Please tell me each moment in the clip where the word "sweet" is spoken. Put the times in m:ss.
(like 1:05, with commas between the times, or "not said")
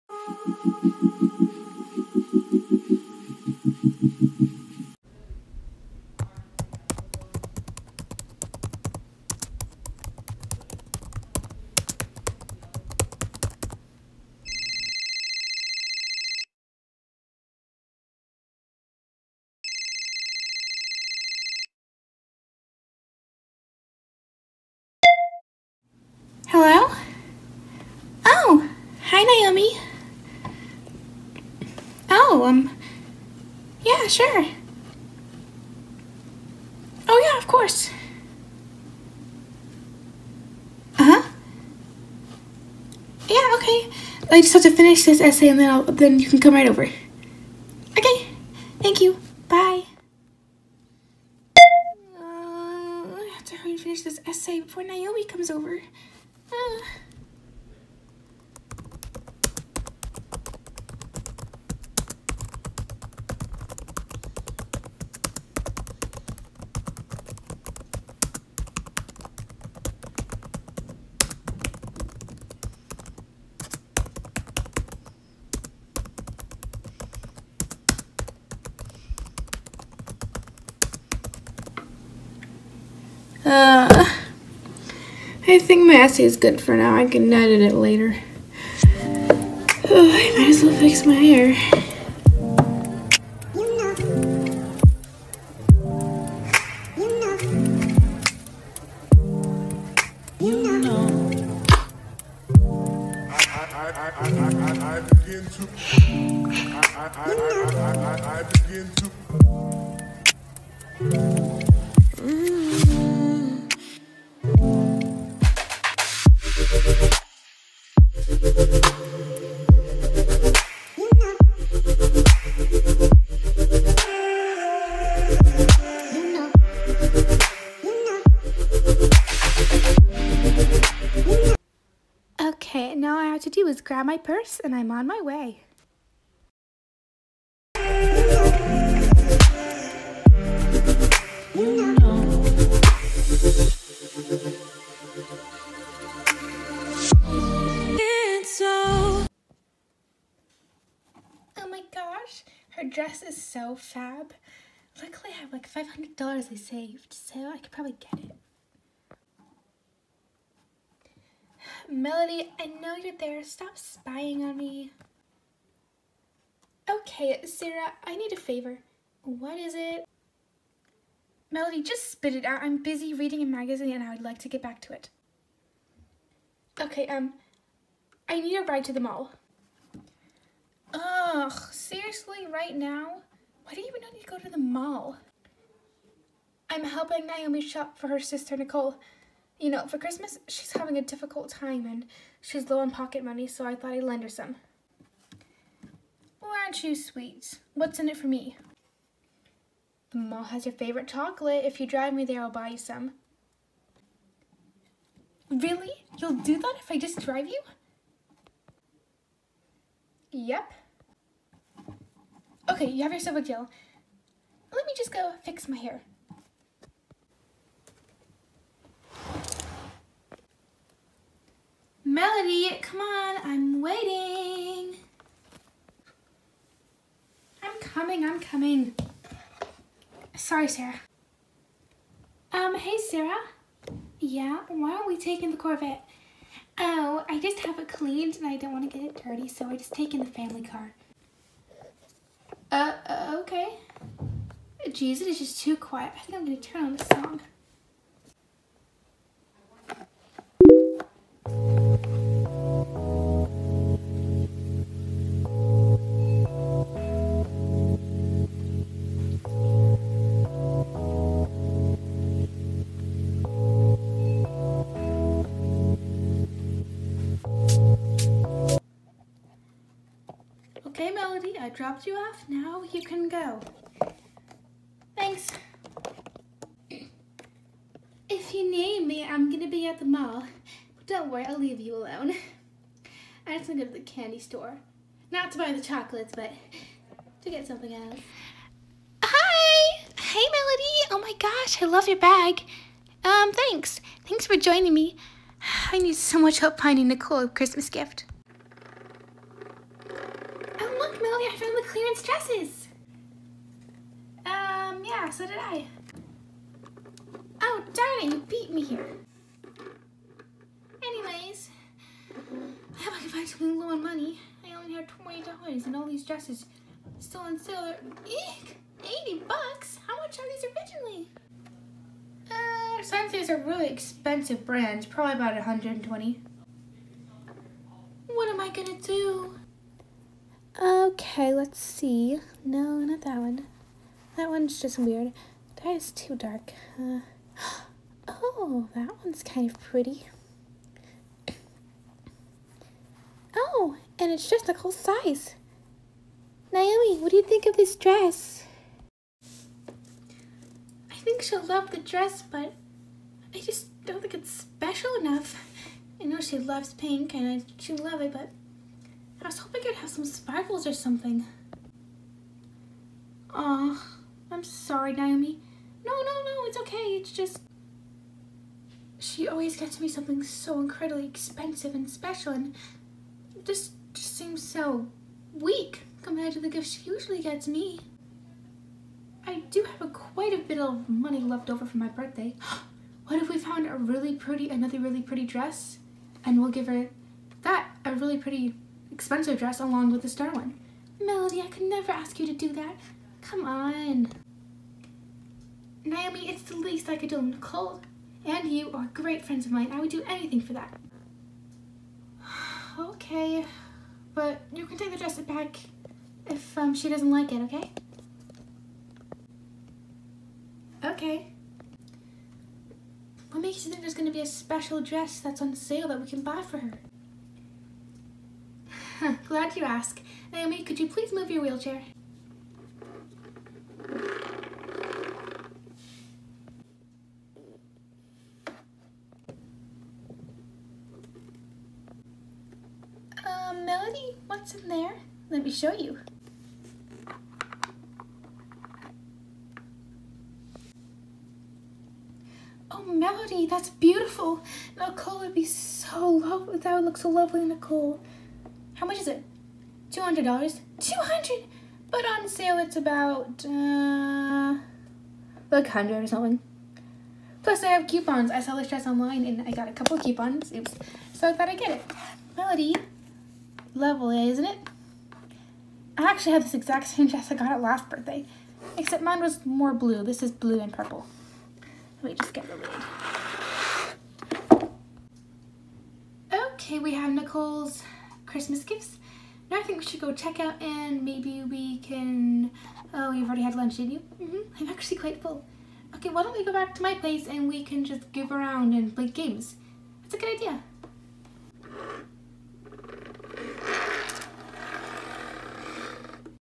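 3:16, 4:31.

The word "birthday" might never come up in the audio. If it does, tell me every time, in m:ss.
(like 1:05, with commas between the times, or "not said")
6:22, 7:48.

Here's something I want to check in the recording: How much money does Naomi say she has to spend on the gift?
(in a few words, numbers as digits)
$20.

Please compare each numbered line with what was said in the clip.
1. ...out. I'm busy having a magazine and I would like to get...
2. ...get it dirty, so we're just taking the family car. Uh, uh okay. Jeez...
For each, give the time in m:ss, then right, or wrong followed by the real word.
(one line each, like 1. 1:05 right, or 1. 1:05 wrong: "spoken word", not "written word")
1. 2:52 wrong: "reading", not "having"
2. 3:58 right.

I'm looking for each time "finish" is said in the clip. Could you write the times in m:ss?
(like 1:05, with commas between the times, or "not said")
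0:44, 0:53.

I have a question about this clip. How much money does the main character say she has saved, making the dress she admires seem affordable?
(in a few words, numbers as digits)
$500.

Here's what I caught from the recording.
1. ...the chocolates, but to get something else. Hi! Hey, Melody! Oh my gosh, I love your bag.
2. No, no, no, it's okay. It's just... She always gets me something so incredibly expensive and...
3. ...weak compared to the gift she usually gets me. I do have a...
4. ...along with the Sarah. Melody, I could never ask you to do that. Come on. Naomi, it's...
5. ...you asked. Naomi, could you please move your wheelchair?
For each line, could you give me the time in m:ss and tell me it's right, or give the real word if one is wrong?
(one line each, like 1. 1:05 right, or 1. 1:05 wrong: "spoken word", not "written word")
1. 4:45 right
2. 6:06 right
3. 6:15 right
4. 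6:29 wrong: "Starlin", not "Sarah"
5. 6:59 right.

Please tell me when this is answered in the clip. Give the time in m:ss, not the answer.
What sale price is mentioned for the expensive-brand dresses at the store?
5:19.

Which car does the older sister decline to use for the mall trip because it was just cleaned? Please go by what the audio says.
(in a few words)
Corvette.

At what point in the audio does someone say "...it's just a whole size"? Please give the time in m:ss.
5:44.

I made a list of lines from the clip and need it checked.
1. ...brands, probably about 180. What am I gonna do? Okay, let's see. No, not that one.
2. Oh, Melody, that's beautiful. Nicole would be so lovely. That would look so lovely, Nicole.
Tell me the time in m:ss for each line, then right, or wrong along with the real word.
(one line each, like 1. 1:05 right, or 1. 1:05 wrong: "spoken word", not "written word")
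1. 5:24 wrong: "120", not "180"
2. 7:22 right.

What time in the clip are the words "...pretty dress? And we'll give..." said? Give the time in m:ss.
6:25.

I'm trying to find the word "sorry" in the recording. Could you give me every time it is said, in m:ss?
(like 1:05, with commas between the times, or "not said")
3:50, 6:04.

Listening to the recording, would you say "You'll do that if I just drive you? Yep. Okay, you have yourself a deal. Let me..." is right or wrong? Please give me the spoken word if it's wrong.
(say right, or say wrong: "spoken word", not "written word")
right.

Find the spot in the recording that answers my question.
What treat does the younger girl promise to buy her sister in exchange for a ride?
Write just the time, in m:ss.
3:21.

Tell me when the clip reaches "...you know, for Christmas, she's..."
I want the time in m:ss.
3:09.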